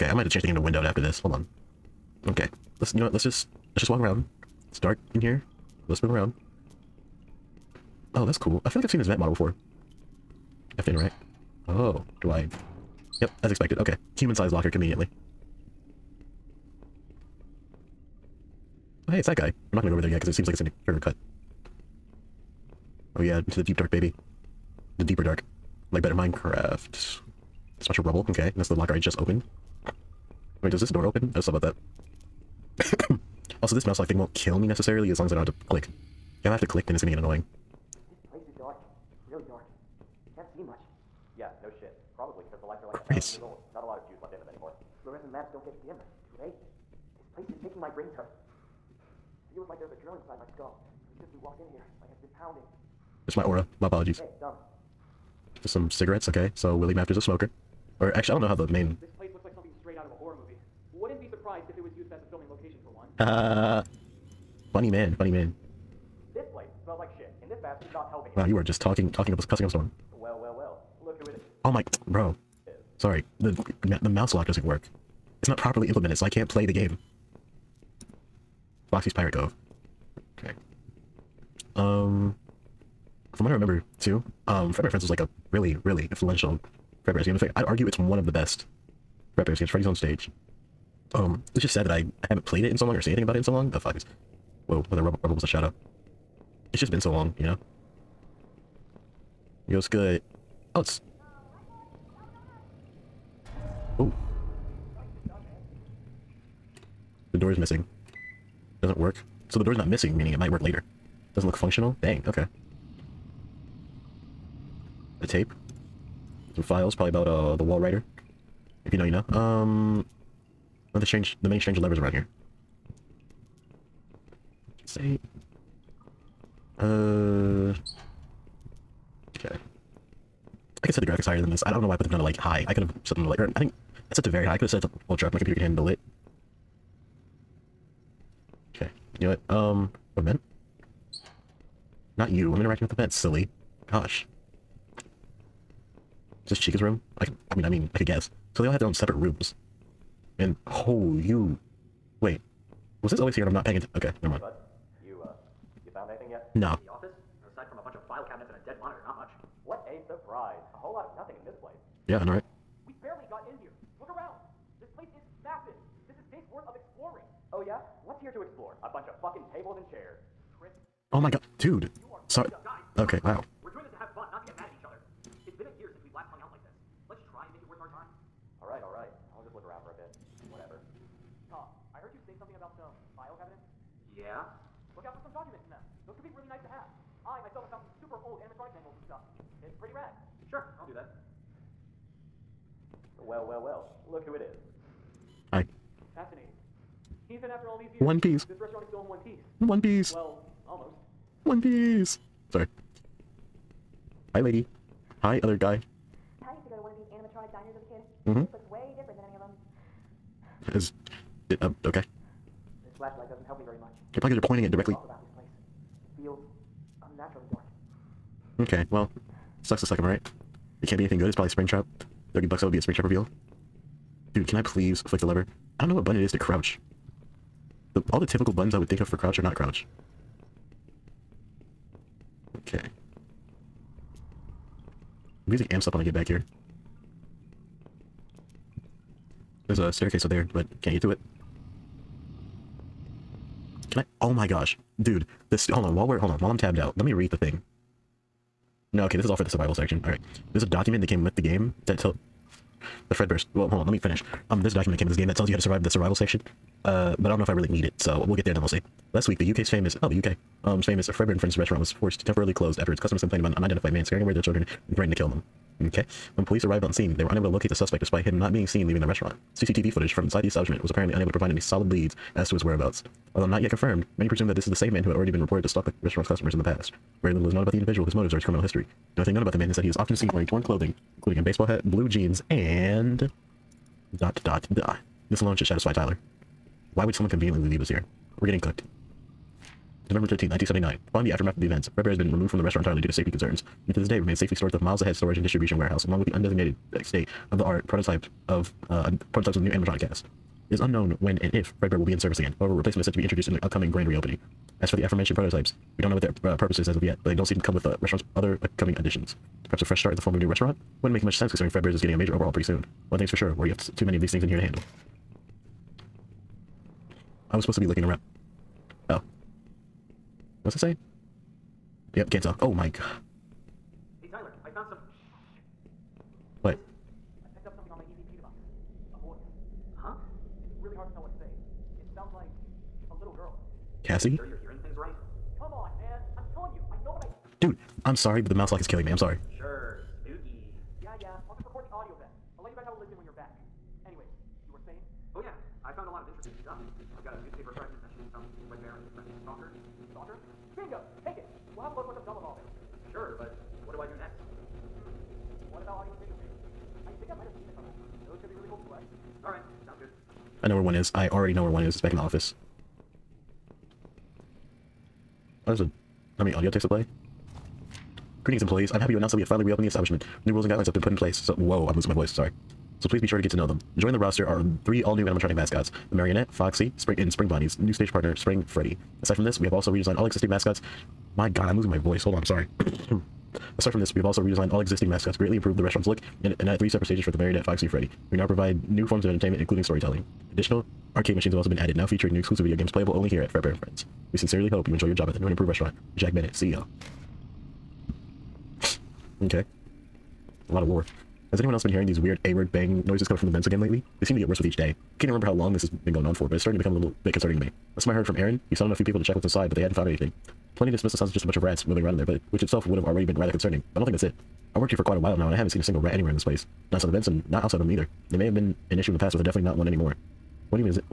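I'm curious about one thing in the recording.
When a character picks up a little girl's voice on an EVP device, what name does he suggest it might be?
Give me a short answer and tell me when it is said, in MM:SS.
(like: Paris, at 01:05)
Cassie, at 05:34.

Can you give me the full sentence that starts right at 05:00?
It is unknown when and if Fredbear will be in service again.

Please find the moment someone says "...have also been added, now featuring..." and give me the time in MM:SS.
06:31.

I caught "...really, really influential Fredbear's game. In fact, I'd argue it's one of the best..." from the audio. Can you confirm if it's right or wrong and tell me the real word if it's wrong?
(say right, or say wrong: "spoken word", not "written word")
right.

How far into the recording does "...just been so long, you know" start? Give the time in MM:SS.
01:36.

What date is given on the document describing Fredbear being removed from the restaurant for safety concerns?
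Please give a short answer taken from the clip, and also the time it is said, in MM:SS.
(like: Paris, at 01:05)
November 13, 1979, at 04:50.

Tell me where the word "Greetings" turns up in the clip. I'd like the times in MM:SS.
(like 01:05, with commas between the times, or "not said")
06:08.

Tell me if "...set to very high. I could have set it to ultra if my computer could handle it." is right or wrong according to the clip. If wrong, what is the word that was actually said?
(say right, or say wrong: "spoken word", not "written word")
right.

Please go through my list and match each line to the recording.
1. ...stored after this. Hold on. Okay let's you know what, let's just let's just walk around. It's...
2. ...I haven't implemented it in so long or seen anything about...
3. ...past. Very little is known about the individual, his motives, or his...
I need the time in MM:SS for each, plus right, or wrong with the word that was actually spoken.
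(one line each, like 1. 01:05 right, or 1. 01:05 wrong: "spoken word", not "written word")
1. 00:00 wrong: "windowed", not "stored"
2. 01:32 wrong: "played", not "implemented"
3. 04:36 right.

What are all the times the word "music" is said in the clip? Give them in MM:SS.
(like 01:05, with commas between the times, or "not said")
03:55.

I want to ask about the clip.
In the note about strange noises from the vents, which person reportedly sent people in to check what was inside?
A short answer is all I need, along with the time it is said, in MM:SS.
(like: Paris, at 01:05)
Aaron, at 06:48.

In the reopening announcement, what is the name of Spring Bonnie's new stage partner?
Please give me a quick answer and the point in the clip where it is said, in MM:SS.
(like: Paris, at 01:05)
Spring Freddy, at 06:18.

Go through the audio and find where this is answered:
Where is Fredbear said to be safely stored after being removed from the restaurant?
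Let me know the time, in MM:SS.
04:54.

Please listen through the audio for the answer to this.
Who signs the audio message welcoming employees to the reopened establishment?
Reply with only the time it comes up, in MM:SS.
06:36.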